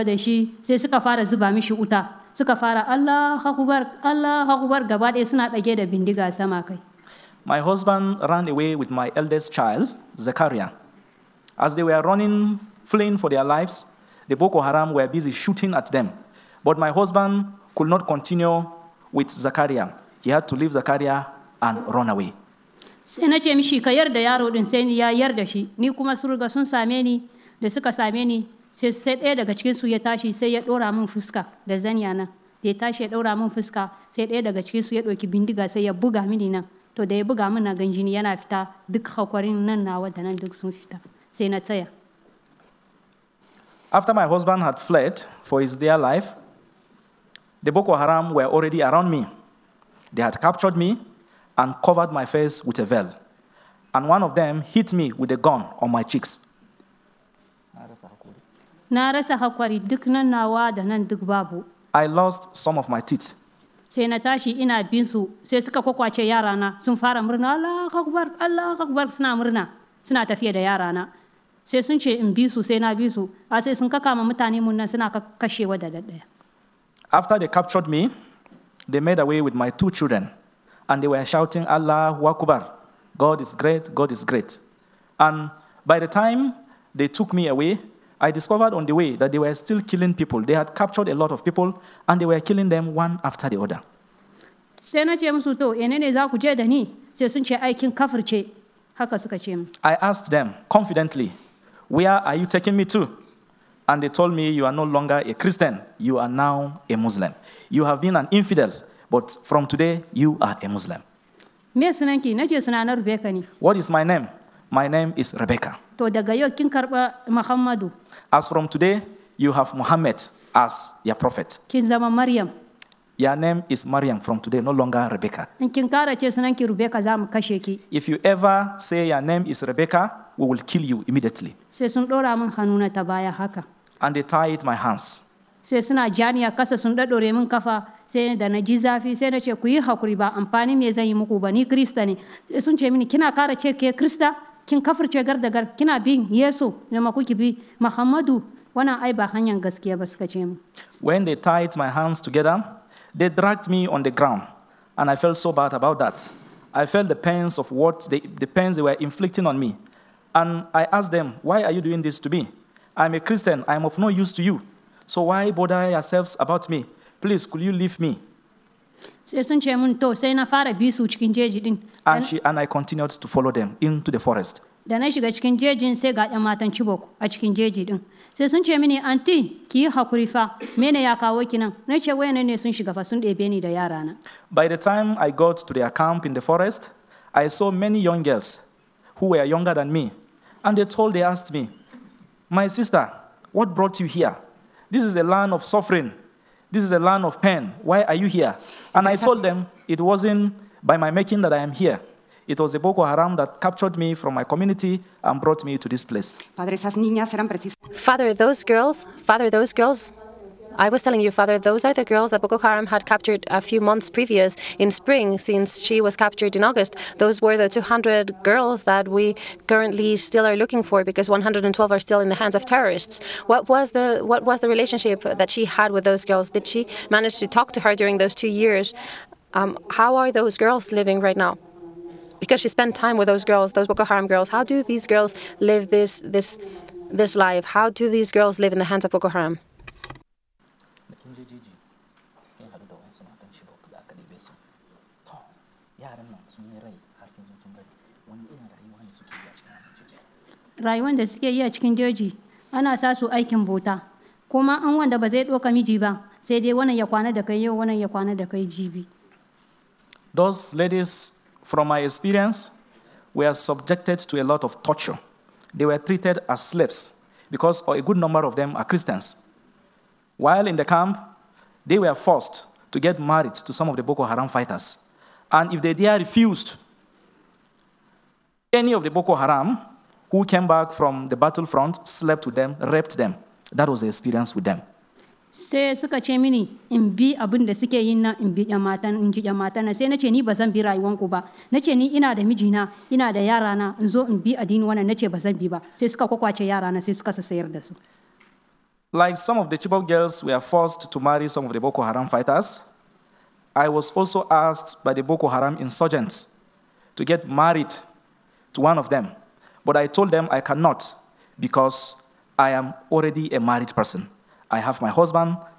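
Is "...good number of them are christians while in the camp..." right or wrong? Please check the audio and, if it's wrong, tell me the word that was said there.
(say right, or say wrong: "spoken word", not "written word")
right.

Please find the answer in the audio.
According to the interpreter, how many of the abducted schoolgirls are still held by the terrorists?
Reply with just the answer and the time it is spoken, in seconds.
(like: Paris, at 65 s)
112, at 221 s.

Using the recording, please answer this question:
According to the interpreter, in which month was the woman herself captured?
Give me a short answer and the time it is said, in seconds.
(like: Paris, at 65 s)
August, at 216 s.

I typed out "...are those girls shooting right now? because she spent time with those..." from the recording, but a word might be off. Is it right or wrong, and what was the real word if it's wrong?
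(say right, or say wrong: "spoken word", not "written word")
wrong: "living", not "shooting".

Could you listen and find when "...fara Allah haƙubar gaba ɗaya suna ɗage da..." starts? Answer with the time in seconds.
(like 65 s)
2 s.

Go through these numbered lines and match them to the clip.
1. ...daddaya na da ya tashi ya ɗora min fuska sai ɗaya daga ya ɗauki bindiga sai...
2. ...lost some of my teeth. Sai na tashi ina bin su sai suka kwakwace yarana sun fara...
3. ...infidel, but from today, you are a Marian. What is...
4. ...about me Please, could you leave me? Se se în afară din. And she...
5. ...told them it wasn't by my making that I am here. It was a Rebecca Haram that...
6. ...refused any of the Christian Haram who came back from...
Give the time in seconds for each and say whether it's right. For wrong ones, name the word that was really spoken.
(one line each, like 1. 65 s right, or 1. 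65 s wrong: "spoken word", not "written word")
1. 31 s wrong: "zaniya", not "daddaya"
2. 62 s right
3. 108 s wrong: "Muslim", not "Marian"
4. 166 s right
5. 199 s wrong: "Boko", not "Rebecca"
6. 276 s wrong: "Boko", not "Christian".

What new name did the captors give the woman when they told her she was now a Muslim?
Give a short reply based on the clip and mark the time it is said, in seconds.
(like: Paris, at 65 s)
Marian, at 123 s.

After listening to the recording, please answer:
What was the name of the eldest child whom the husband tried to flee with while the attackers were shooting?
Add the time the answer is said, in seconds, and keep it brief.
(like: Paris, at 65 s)
Zakariya, at 10 s.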